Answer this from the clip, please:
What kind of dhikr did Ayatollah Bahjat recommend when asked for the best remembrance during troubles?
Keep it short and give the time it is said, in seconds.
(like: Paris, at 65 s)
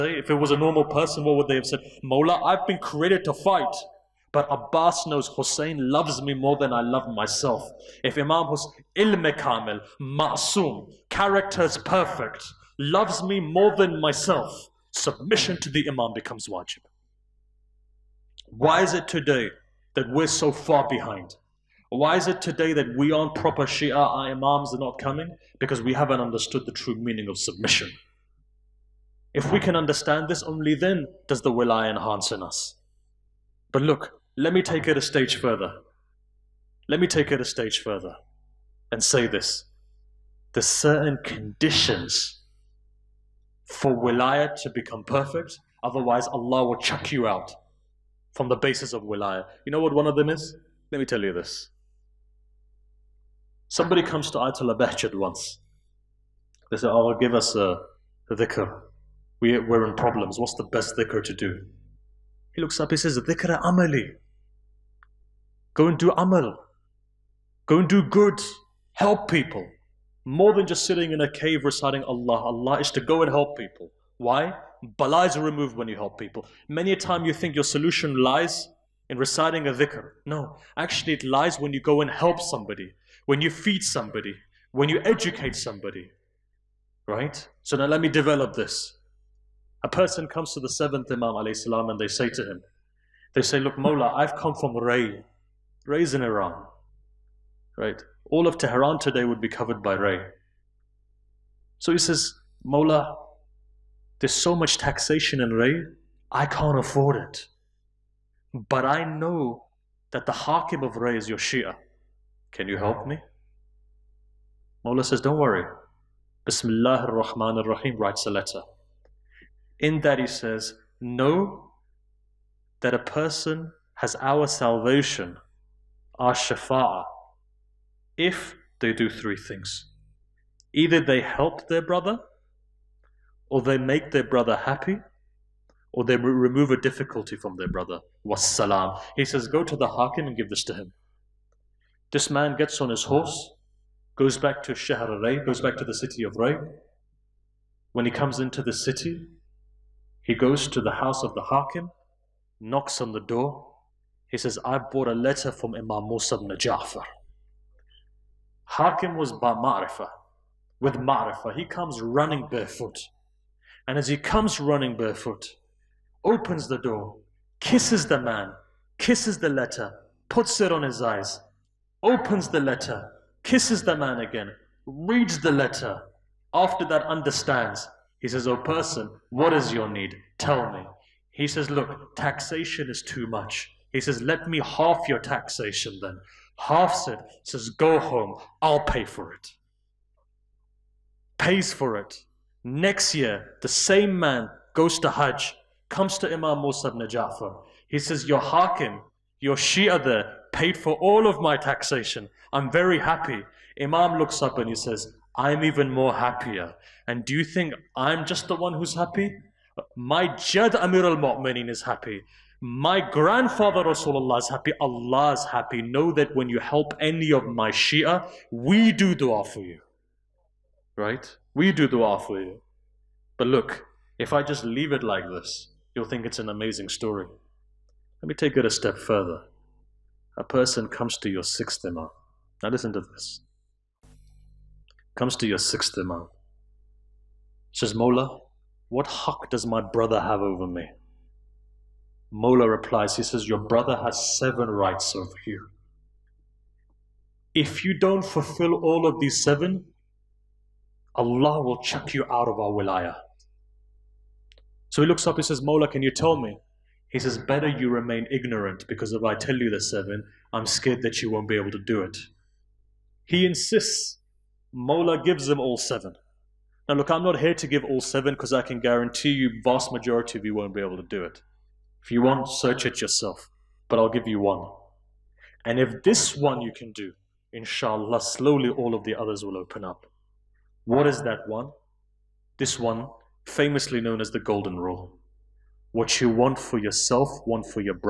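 dhikr amali, at 63 s.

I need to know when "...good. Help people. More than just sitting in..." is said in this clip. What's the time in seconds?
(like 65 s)
68 s.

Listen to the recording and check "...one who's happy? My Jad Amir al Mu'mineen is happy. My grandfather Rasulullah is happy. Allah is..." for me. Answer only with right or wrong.
right.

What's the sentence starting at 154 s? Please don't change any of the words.
He says, I brought a letter from Imam Musa ibn Ja'far.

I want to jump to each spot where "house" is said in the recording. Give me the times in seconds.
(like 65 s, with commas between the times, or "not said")
150 s.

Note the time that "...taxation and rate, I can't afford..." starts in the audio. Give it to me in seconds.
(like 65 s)
104 s.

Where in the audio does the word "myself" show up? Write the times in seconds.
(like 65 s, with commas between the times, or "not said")
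7 s, 13 s.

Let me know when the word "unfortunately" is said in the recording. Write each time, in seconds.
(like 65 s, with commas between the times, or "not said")
not said.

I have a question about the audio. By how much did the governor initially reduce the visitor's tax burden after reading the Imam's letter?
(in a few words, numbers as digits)
half.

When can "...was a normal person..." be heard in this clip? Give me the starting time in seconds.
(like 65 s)
0 s.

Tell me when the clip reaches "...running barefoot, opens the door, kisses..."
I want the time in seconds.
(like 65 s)
164 s.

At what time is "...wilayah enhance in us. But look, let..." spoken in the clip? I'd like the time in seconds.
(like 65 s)
31 s.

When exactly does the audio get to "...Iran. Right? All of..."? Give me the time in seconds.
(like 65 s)
96 s.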